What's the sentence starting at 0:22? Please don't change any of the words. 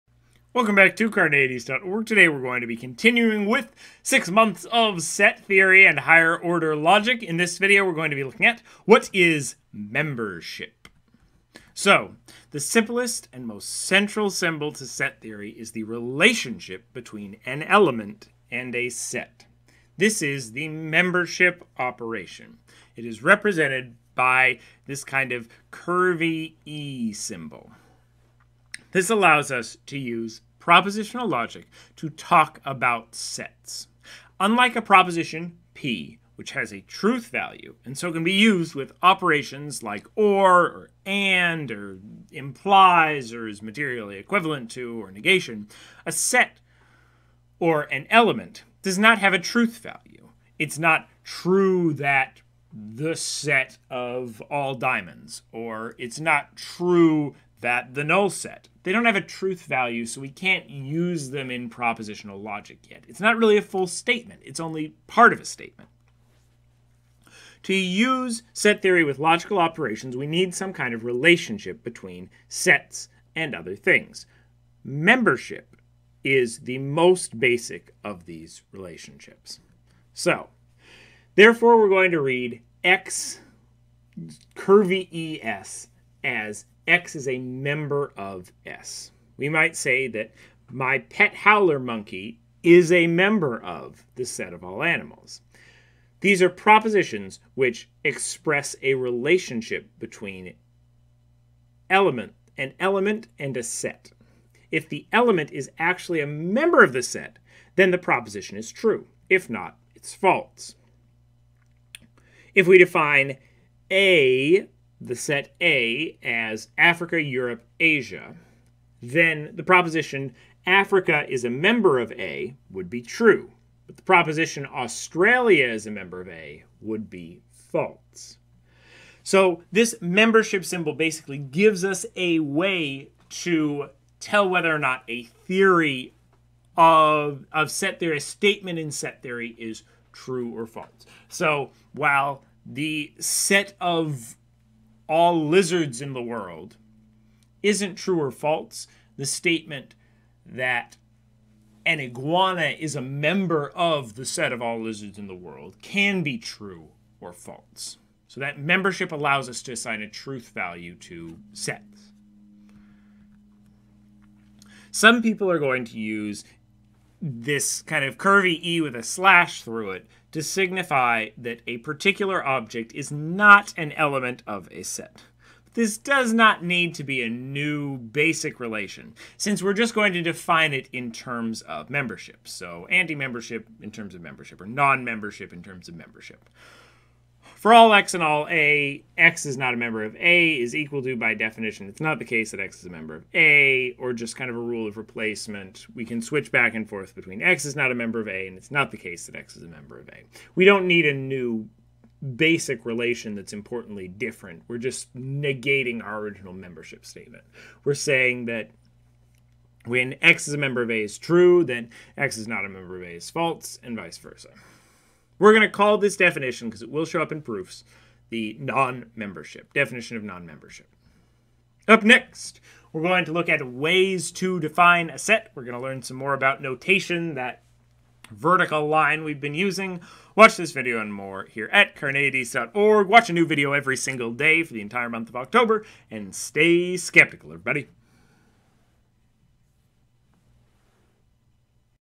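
It is represented by this kind of curvy E symbol.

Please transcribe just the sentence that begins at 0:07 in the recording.
In this video, we're going to be looking at what is membership.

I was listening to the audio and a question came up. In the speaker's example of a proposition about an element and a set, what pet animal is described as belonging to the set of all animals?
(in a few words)
Howler monkey.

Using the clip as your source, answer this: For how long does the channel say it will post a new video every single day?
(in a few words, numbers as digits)
The entire month of October.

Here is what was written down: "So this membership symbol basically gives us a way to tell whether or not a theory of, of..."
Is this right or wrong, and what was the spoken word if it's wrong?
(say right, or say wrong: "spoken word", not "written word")
right.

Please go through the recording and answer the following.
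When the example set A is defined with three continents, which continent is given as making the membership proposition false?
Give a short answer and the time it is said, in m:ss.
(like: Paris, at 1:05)
Australia, at 2:04.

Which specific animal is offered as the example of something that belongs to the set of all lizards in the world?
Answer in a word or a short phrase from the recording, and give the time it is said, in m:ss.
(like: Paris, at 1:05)
Iguana, at 2:31.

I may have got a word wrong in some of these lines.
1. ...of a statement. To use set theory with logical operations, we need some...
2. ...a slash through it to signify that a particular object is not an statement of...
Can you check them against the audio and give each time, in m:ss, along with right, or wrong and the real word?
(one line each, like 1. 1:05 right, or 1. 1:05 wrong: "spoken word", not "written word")
1. 1:05 right
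2. 2:48 wrong: "element", not "statement".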